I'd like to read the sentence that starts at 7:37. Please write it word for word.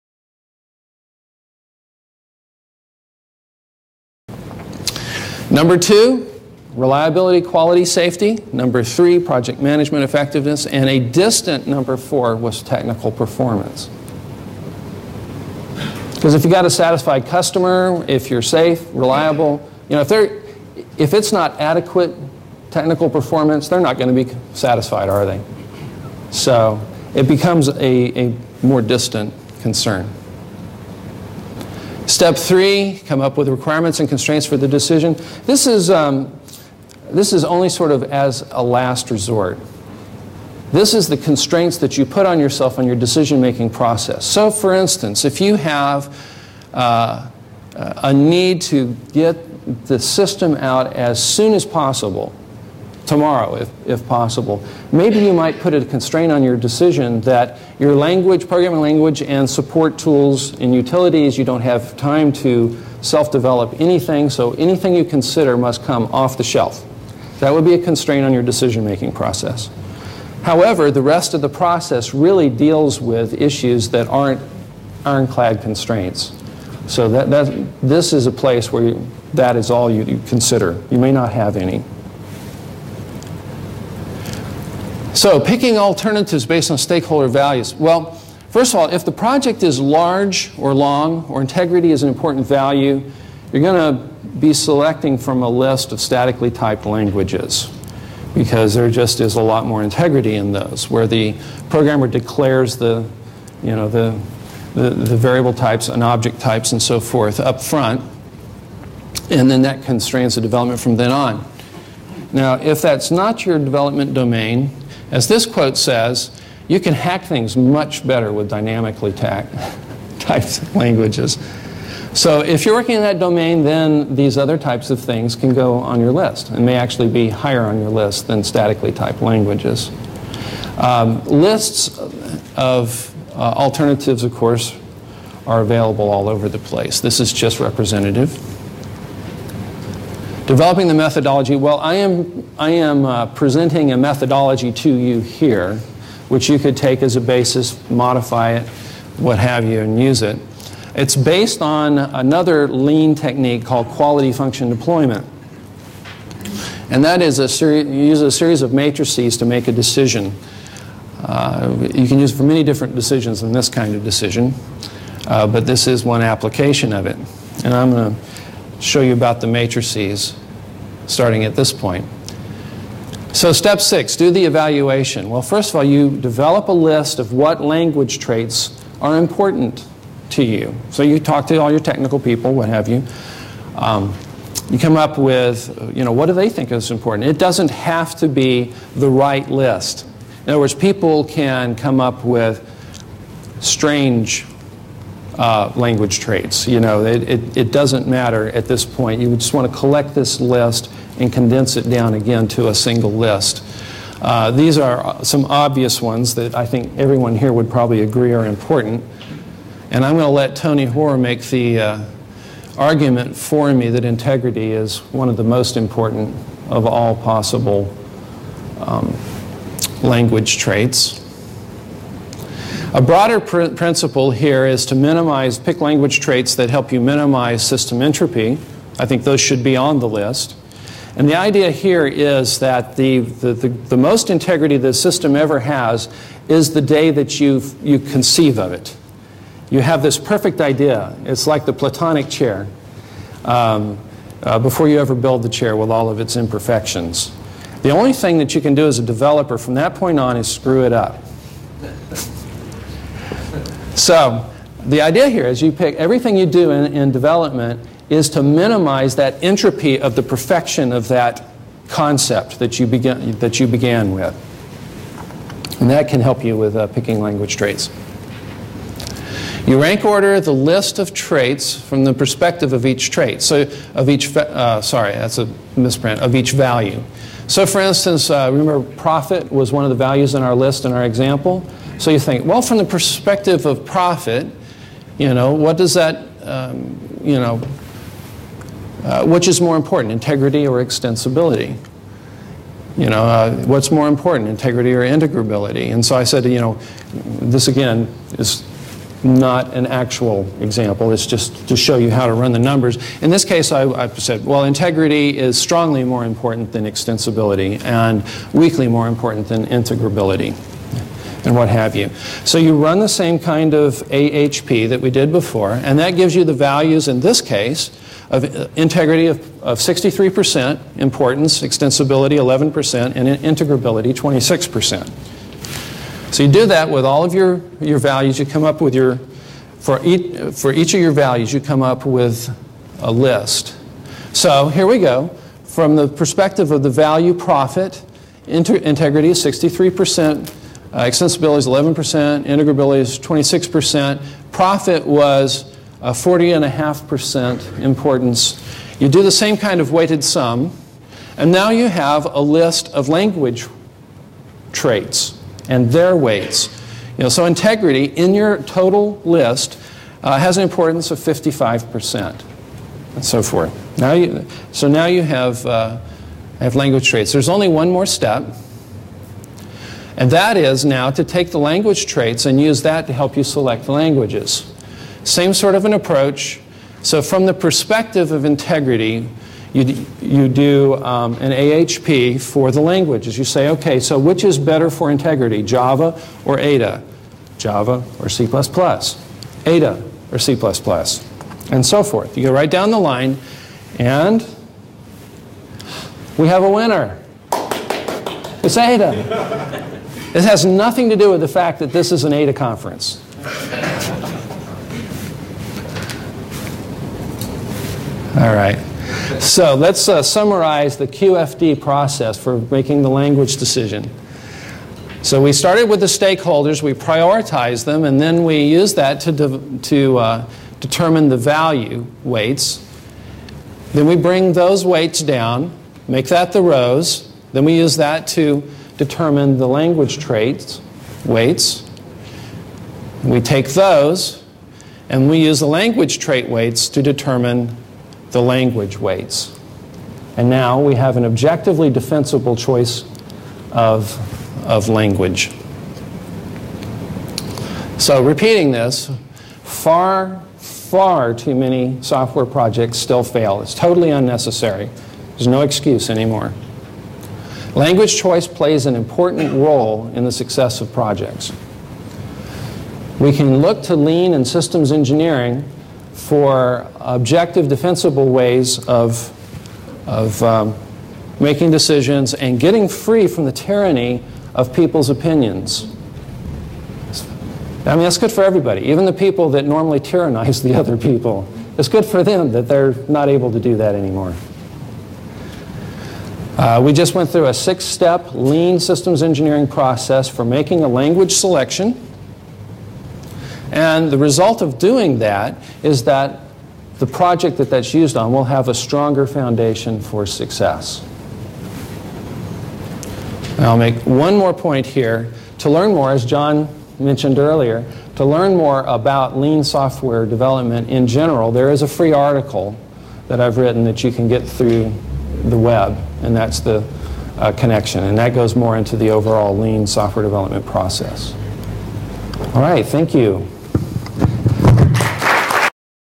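Language choice plays an important role in the success of projects.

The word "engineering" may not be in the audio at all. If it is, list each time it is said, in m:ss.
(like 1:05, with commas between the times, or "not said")
7:44, 8:09.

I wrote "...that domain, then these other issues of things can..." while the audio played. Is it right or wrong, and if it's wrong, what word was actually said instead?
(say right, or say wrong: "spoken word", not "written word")
wrong: "types", not "issues".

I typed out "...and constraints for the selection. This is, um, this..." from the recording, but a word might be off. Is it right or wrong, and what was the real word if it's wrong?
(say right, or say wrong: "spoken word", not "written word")
wrong: "decision", not "selection".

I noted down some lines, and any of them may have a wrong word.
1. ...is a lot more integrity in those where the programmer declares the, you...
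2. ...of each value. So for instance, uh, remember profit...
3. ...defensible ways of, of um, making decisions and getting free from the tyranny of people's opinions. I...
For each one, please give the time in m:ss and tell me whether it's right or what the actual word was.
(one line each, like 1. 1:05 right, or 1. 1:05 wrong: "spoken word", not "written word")
1. 1:39 right
2. 4:36 right
3. 7:47 right.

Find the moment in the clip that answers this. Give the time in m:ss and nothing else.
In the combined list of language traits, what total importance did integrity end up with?
6:01.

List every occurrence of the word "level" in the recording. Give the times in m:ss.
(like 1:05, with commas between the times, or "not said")
not said.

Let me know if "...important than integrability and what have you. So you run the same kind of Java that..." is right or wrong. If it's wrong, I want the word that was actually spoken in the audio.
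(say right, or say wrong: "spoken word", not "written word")
wrong: "AHP", not "Java".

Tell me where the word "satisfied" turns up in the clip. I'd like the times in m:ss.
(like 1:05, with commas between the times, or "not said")
0:16, 0:24.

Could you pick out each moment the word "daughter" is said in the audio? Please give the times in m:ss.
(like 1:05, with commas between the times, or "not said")
not said.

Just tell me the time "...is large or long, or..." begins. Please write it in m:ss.
1:29.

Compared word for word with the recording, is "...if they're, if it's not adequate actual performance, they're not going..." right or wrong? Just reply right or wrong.
wrong.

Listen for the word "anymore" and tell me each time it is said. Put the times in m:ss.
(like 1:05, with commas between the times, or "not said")
7:36, 8:03.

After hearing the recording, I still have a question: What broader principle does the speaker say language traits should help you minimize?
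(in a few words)
System entropy.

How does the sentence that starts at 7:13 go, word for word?
We take those, and we use the language trait weights to determine the language weights.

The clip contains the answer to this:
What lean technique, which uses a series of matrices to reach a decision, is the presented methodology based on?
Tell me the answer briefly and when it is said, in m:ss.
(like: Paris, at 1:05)
Quality function deployment, at 2:33.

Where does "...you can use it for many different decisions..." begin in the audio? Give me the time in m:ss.
2:41.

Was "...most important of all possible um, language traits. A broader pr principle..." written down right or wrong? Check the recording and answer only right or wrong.
right.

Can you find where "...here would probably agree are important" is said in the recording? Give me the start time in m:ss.
3:27.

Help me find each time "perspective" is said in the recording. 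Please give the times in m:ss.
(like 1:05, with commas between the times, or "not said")
4:32, 4:42, 5:36, 6:17.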